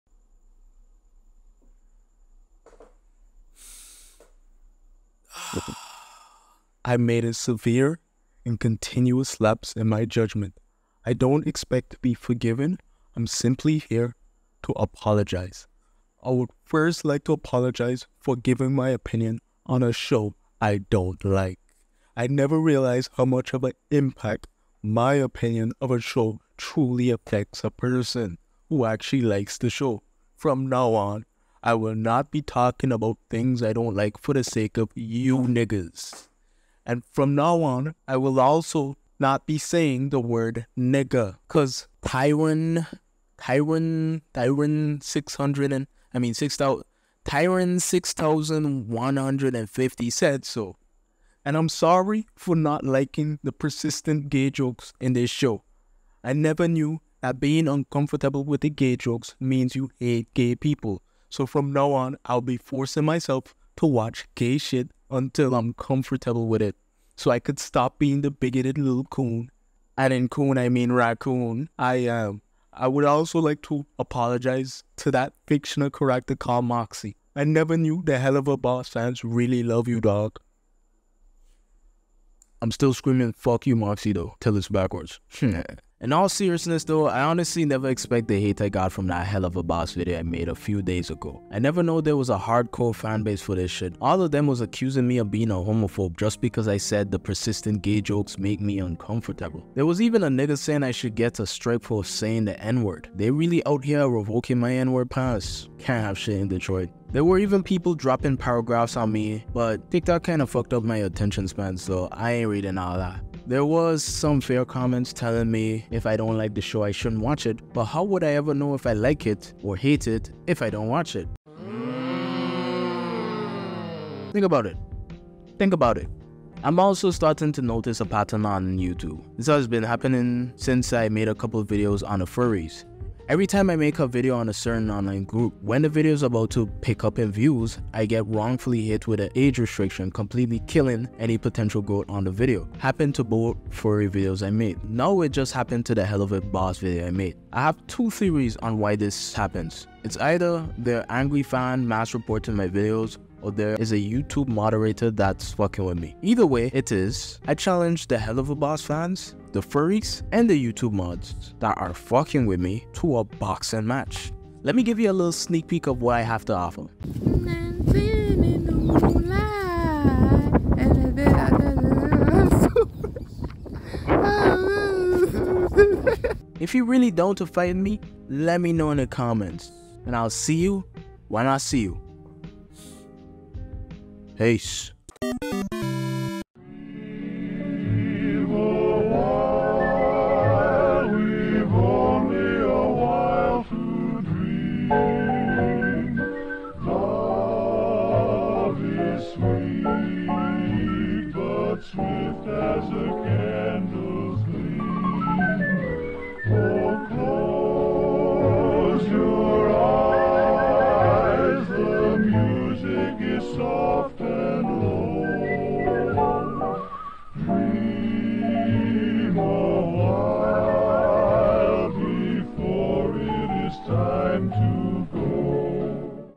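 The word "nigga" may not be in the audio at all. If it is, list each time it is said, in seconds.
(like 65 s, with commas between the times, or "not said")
35 s, 40 s, 100 s.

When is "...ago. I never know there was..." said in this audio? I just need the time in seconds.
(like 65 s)
91 s.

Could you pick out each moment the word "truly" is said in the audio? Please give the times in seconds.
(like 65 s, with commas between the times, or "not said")
26 s.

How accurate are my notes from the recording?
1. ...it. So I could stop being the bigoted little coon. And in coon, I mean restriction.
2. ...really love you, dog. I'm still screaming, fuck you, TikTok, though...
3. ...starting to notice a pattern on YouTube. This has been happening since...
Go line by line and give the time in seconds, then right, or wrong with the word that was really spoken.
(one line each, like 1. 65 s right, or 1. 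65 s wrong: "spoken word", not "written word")
1. 66 s wrong: "raccoon", not "restriction"
2. 79 s wrong: "Moxxie", not "TikTok"
3. 127 s right.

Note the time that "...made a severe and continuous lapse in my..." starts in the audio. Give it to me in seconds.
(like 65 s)
6 s.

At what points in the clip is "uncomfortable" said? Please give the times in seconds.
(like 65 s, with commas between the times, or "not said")
57 s, 98 s.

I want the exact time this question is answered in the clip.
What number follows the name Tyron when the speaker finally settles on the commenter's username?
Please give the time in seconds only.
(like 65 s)
47 s.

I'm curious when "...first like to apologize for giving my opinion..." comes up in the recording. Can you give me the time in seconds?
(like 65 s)
16 s.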